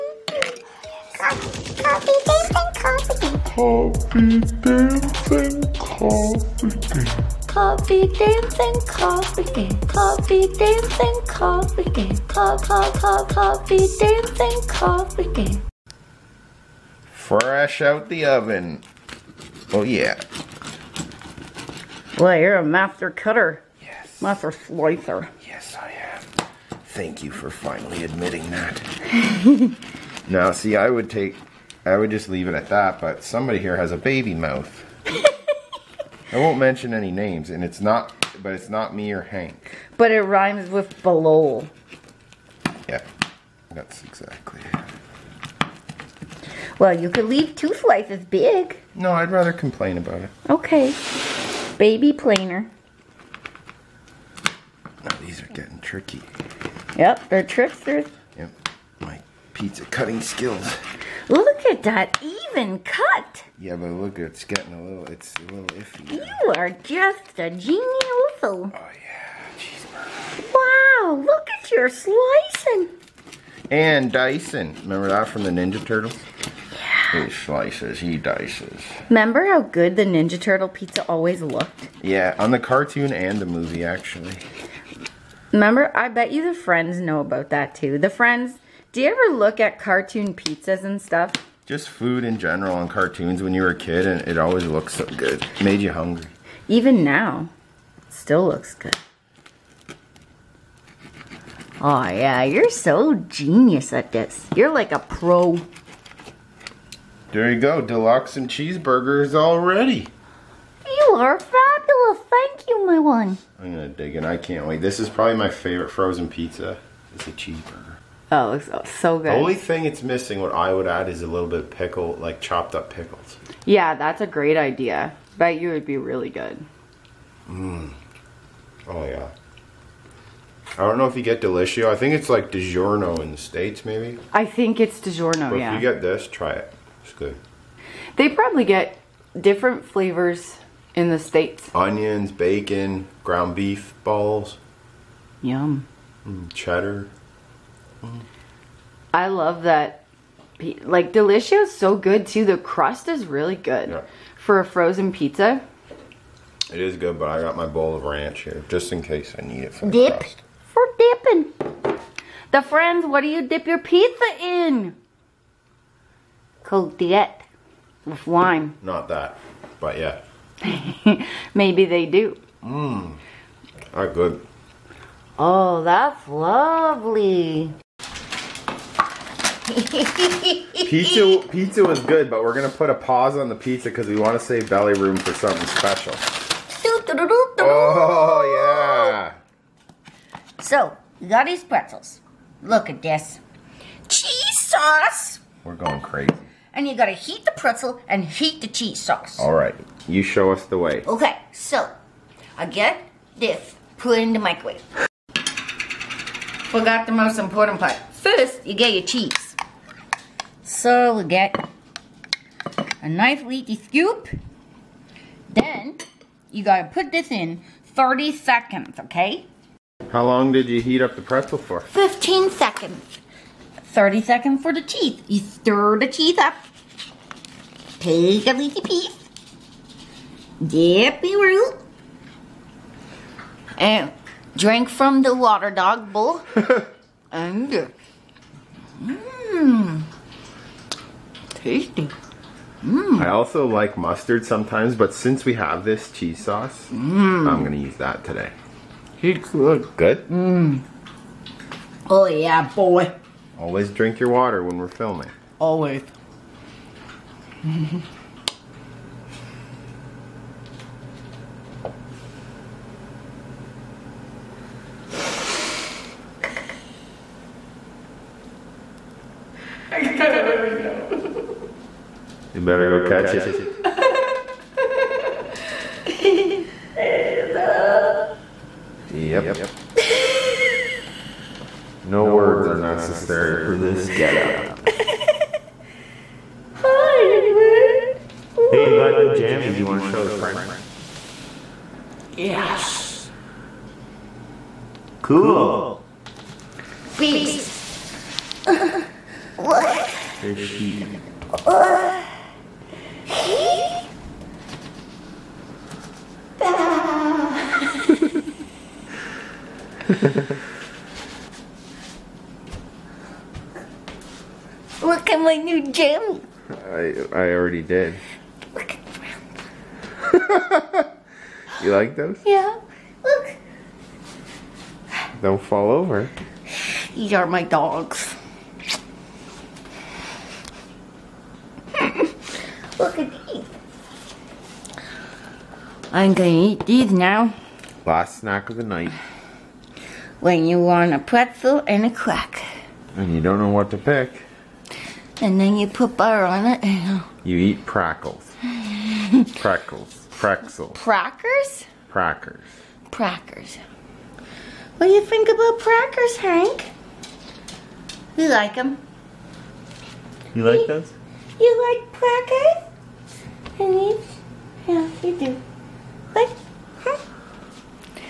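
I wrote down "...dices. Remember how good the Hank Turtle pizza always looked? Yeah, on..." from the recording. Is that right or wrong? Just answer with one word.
wrong.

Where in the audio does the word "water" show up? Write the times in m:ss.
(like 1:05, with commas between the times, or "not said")
3:55, 4:14.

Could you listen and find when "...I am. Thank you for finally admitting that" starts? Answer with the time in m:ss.
0:25.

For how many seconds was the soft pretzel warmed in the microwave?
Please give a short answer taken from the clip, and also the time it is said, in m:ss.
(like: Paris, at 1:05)
15 seconds, at 3:41.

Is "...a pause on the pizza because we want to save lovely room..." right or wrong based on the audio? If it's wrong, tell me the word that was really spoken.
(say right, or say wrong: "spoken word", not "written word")
wrong: "belly", not "lovely".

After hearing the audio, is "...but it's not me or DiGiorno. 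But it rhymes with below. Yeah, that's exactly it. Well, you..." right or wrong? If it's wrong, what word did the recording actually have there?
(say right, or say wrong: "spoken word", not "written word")
wrong: "Hank", not "DiGiorno".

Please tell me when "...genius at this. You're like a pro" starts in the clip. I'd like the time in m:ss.
1:43.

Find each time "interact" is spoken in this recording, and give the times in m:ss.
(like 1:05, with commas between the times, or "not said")
not said.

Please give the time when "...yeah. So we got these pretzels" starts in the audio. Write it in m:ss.
3:08.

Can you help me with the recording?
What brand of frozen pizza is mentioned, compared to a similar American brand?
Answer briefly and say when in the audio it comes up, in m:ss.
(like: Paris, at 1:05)
Delissio, at 2:11.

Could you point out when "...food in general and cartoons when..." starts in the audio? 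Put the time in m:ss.
1:31.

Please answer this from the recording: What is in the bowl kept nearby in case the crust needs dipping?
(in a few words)
Ranch.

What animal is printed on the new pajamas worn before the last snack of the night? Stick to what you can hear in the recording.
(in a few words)
Sheep.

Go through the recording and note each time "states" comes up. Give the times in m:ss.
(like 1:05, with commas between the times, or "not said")
2:13, 2:21.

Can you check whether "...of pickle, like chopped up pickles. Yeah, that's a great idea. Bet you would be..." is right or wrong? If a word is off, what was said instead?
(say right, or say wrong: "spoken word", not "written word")
right.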